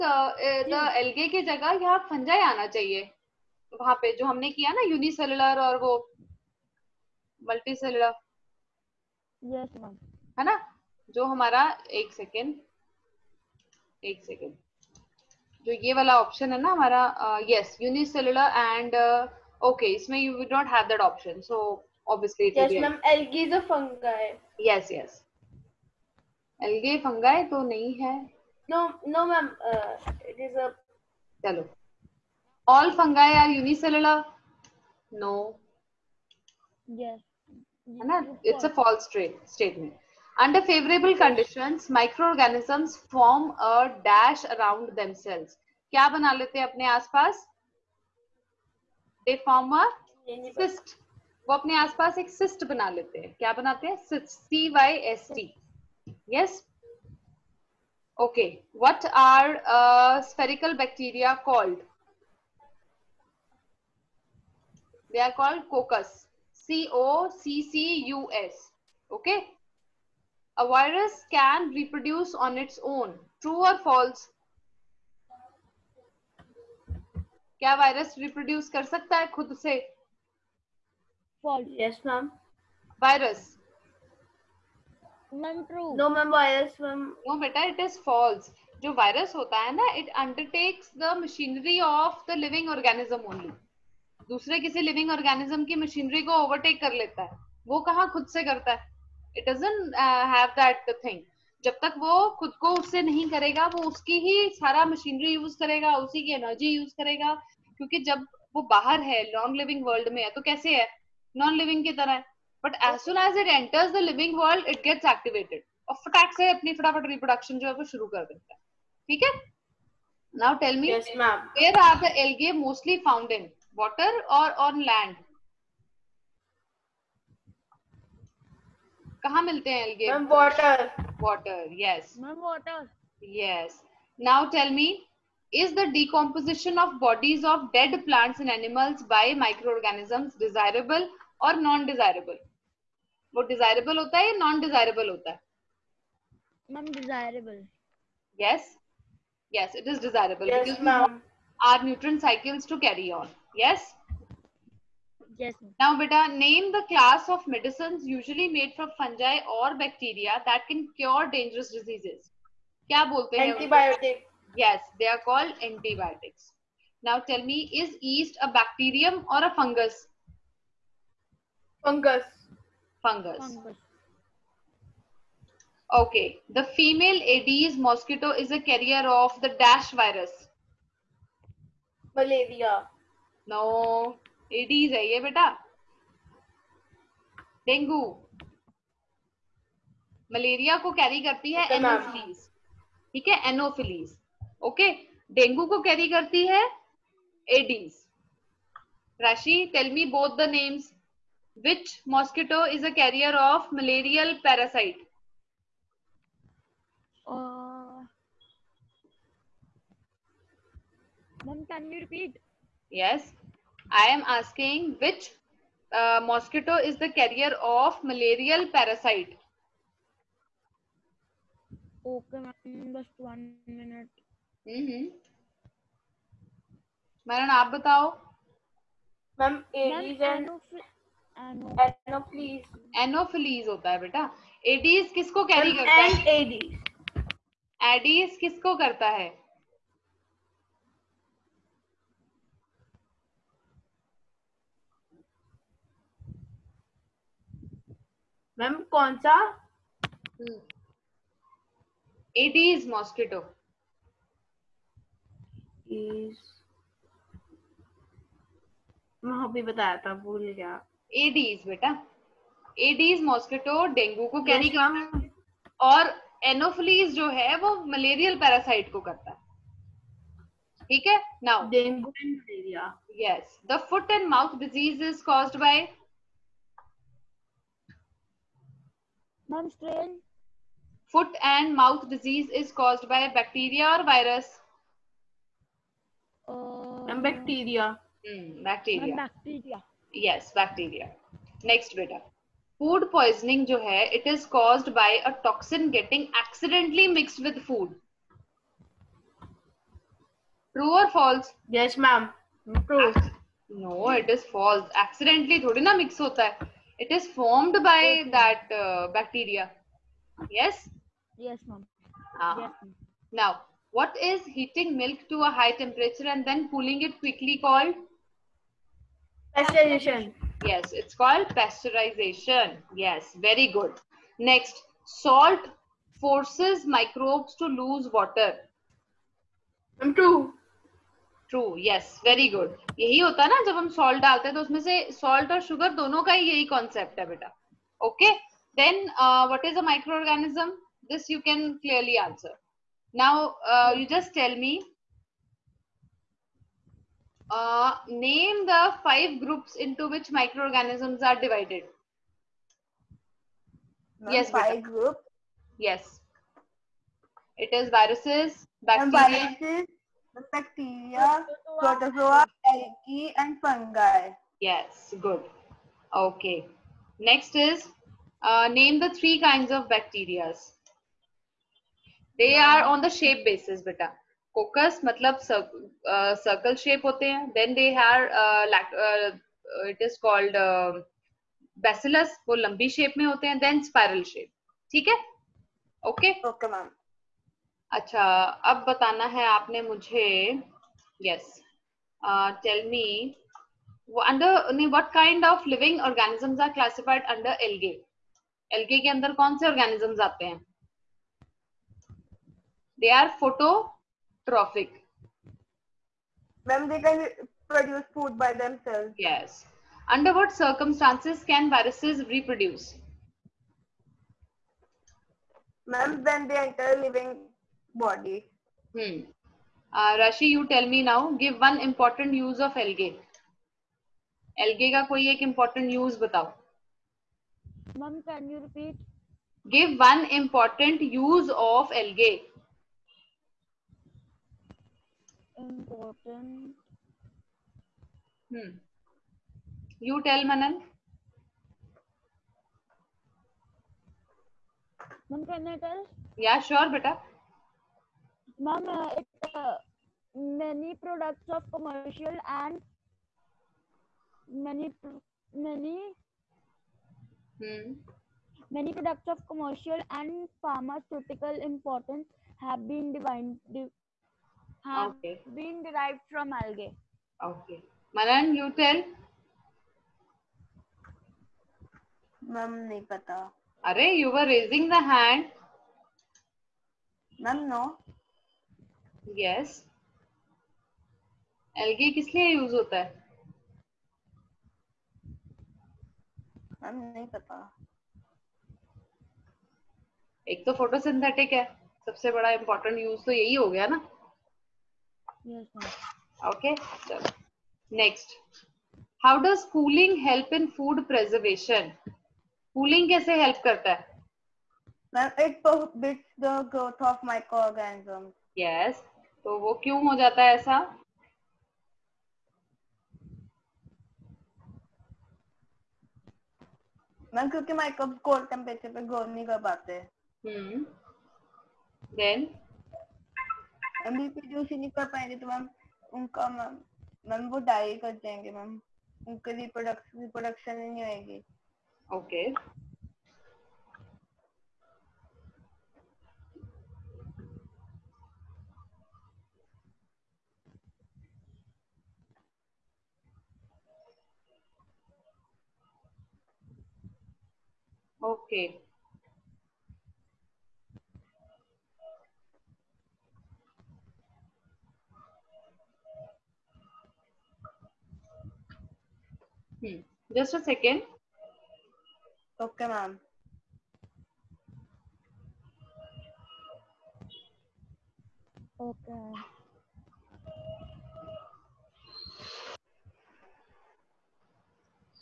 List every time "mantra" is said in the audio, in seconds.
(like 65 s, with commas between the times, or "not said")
not said.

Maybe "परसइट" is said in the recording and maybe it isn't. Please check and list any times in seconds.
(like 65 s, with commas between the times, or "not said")
268 s.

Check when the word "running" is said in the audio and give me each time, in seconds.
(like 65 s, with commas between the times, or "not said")
not said.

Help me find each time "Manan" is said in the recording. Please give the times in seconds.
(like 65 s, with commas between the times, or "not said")
440 s, 468 s.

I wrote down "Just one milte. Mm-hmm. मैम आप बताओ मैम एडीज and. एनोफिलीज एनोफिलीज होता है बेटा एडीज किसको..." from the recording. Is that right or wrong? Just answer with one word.
wrong.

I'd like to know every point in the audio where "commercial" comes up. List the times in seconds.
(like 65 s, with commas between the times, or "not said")
451 s, 459 s.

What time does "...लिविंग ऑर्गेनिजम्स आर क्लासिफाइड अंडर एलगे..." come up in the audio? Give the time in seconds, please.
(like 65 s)
395 s.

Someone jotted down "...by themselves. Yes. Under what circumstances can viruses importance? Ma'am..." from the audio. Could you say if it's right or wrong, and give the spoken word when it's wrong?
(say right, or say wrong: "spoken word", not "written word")
wrong: "reproduce", not "importance".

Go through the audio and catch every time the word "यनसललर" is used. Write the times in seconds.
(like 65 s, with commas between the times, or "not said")
4 s, 17 s.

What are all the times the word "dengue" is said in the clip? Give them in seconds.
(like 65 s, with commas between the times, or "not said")
187 s.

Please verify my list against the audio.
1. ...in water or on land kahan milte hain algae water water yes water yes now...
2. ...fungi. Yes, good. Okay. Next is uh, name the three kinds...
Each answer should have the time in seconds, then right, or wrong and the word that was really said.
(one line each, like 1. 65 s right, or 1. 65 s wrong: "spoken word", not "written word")
1. 123 s right
2. 363 s right.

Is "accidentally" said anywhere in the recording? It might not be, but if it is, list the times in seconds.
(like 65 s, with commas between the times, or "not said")
296 s, 305 s.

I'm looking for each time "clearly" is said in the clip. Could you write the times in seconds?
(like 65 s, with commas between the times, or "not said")
341 s.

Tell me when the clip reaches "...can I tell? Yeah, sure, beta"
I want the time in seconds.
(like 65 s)
445 s.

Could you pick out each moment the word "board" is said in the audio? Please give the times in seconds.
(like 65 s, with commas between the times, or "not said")
not said.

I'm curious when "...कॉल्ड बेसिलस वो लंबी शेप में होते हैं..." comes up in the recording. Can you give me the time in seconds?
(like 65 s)
380 s.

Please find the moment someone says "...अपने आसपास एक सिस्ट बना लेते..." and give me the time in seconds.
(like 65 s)
51 s.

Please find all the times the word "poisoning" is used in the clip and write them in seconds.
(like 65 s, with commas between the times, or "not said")
293 s.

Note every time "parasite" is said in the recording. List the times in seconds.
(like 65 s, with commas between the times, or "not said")
204 s, 218 s.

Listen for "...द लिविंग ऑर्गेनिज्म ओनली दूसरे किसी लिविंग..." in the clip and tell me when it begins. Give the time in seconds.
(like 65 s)
92 s.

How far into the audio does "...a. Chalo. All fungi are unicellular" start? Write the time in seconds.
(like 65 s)
30 s.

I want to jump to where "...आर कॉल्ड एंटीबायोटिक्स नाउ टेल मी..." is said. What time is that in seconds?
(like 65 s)
165 s.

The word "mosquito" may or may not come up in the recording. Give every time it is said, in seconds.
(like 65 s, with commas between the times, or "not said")
177 s, 202 s, 216 s.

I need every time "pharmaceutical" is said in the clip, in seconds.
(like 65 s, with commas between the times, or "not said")
460 s.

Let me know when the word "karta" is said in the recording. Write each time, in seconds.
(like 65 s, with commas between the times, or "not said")
503 s.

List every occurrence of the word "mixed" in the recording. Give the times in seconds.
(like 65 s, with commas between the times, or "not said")
297 s.